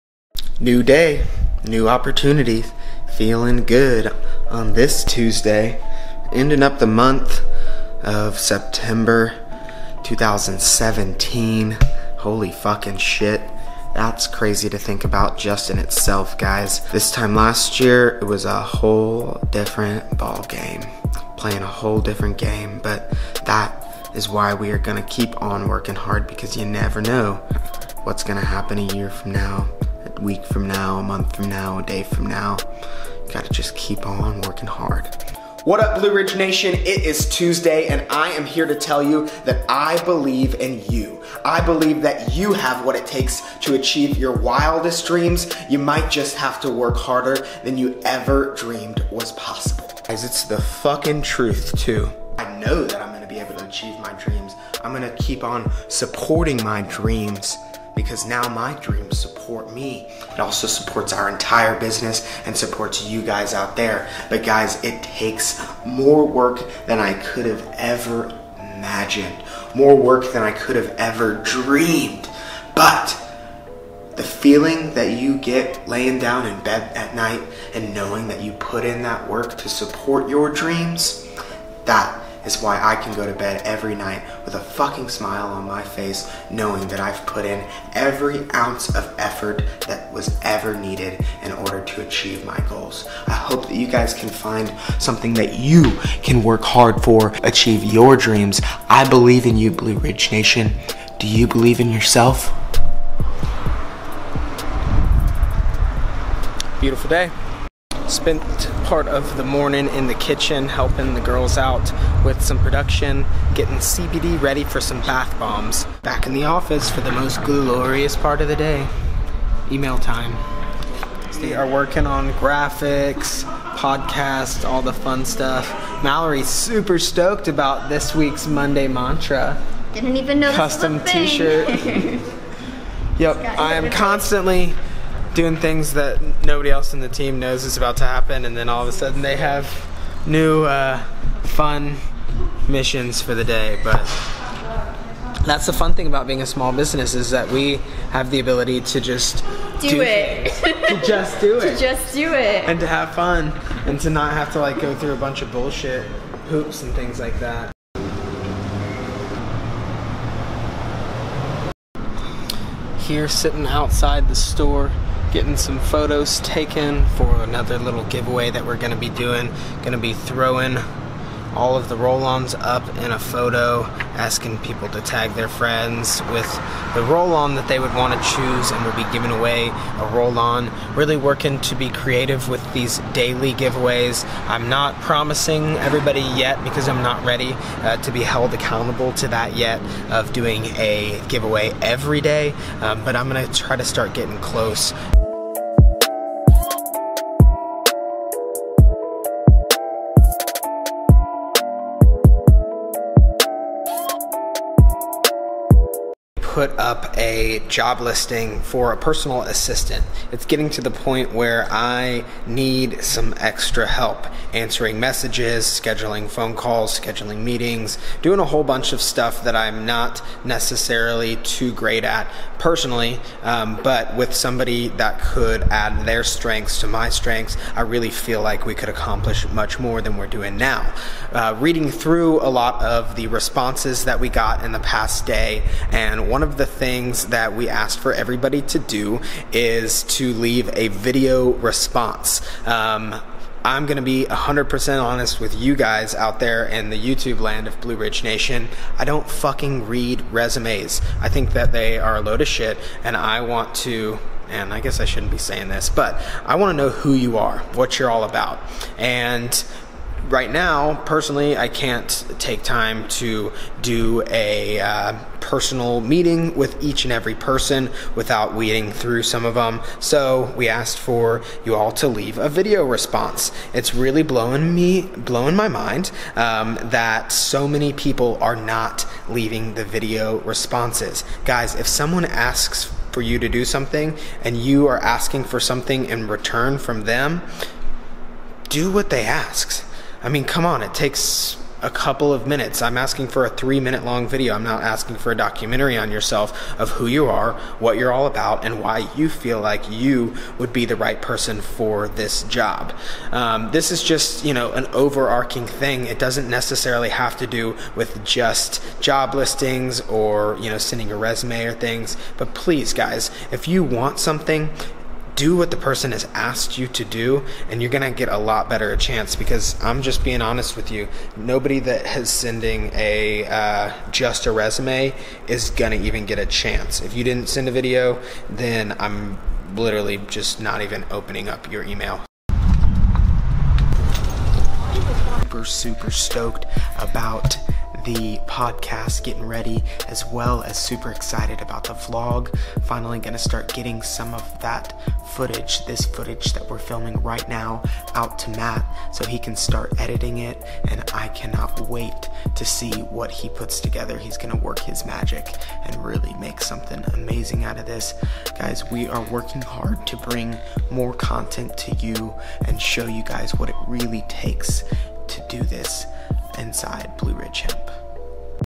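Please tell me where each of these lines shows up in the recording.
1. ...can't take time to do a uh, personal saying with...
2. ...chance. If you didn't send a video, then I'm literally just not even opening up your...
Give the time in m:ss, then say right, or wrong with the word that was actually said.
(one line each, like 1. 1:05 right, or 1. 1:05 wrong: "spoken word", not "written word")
1. 4:21 wrong: "meeting", not "saying"
2. 5:26 right.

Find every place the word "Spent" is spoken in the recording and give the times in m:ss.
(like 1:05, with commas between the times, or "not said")
1:48.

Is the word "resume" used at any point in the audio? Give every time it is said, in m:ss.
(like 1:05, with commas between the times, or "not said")
4:10, 5:11, 5:24.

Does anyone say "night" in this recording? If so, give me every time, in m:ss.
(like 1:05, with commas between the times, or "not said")
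1:17, 1:23.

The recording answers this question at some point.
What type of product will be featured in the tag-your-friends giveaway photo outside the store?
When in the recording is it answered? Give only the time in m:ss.
2:51.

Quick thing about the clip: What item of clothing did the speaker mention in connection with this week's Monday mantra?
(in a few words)
custom T-shirt.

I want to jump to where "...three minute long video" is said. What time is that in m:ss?
4:53.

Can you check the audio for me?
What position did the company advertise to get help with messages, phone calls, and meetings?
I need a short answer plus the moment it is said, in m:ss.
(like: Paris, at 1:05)
personal assistant, at 3:28.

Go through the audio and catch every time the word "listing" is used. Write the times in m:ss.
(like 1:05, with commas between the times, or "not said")
3:27, 5:09.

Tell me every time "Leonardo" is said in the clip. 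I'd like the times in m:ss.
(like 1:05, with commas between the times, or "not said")
not said.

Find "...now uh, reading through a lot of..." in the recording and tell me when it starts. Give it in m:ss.
3:50.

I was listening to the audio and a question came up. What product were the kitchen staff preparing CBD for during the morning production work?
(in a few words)
bath bombs.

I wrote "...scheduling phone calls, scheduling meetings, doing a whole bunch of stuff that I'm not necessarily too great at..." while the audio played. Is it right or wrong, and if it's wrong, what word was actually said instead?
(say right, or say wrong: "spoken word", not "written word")
right.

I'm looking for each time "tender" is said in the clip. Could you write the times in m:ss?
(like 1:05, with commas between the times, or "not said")
not said.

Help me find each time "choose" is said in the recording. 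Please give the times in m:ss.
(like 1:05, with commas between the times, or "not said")
2:58.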